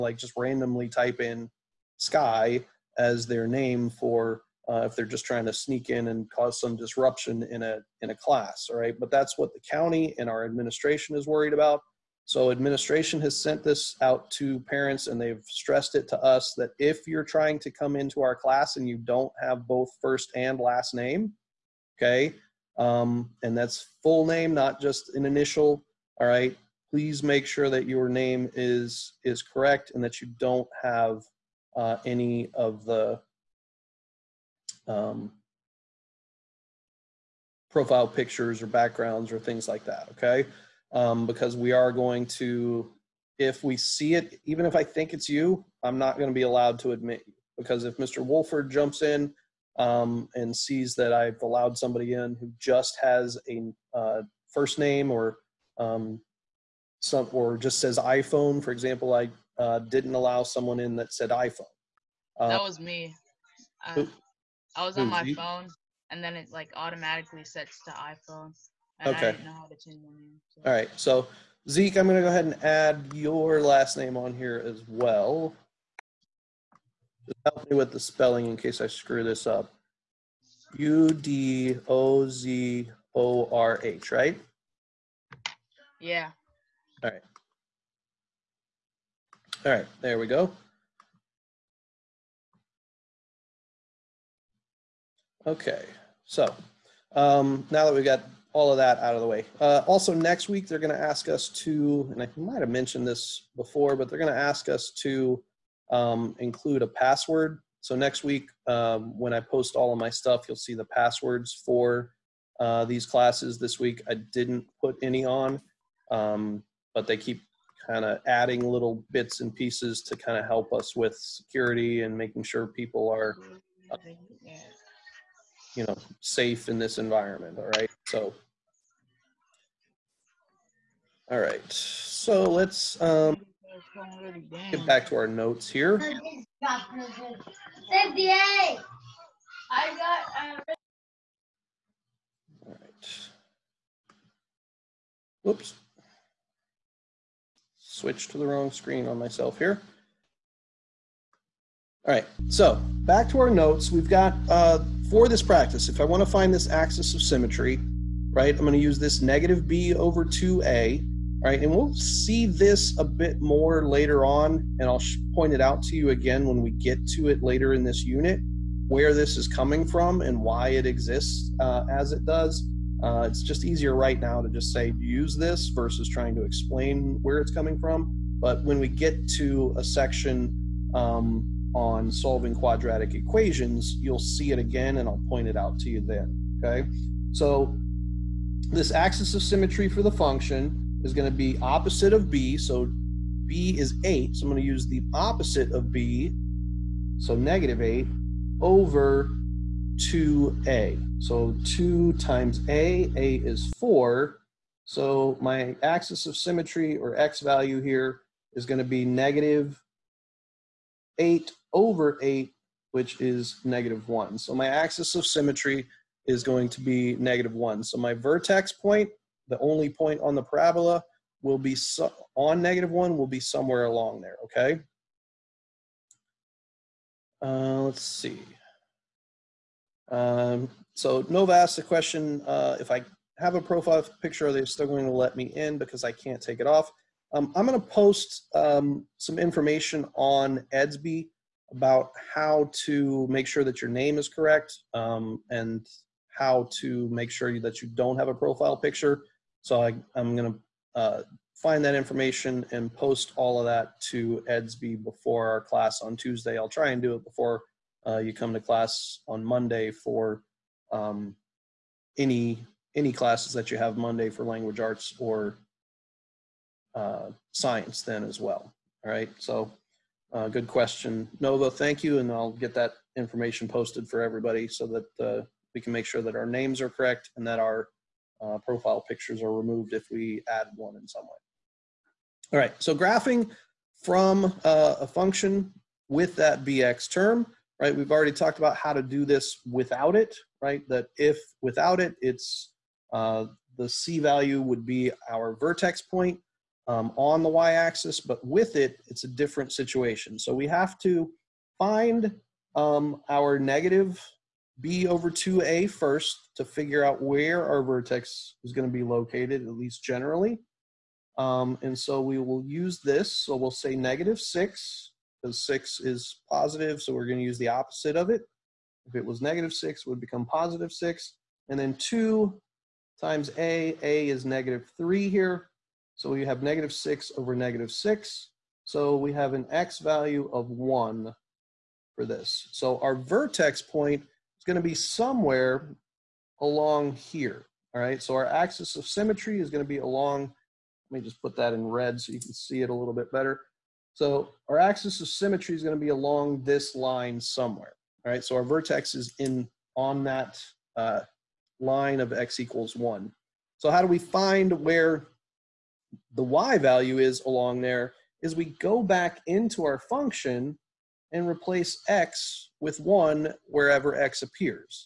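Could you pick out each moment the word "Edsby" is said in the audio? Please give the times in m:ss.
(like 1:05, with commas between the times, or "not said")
4:00, 4:14.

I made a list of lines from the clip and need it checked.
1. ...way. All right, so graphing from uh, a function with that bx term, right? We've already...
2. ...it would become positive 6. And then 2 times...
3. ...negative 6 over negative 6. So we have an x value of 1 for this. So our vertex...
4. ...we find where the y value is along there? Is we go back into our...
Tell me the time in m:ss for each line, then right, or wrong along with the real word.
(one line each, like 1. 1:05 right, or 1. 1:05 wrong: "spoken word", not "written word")
1. 4:41 right
2. 5:20 right
3. 5:26 right
4. 5:54 right.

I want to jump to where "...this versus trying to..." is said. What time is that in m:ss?
2:55.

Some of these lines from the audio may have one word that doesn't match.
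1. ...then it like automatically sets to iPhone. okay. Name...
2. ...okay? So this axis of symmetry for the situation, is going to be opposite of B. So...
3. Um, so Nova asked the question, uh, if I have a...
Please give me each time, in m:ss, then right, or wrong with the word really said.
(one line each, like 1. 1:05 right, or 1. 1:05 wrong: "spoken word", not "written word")
1. 1:06 right
2. 3:06 wrong: "function", not "situation"
3. 3:50 right.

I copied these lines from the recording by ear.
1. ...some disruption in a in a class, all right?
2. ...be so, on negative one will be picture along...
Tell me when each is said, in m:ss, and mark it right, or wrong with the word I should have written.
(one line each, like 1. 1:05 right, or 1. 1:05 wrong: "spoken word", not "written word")
1. 0:06 right
2. 3:41 wrong: "somewhere", not "picture".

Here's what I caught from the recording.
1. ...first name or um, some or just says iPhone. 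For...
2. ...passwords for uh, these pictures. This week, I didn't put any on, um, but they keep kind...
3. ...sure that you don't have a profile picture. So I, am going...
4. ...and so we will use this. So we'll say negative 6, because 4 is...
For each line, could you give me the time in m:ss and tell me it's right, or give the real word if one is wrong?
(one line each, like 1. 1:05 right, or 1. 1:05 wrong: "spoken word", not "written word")
1. 0:54 right
2. 1:50 wrong: "classes", not "pictures"
3. 4:07 right
4. 5:11 wrong: "6", not "4".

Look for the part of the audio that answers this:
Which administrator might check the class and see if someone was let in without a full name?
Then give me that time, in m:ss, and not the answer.
0:47.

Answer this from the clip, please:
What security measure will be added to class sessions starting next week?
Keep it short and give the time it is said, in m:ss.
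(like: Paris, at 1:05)
A password, at 1:46.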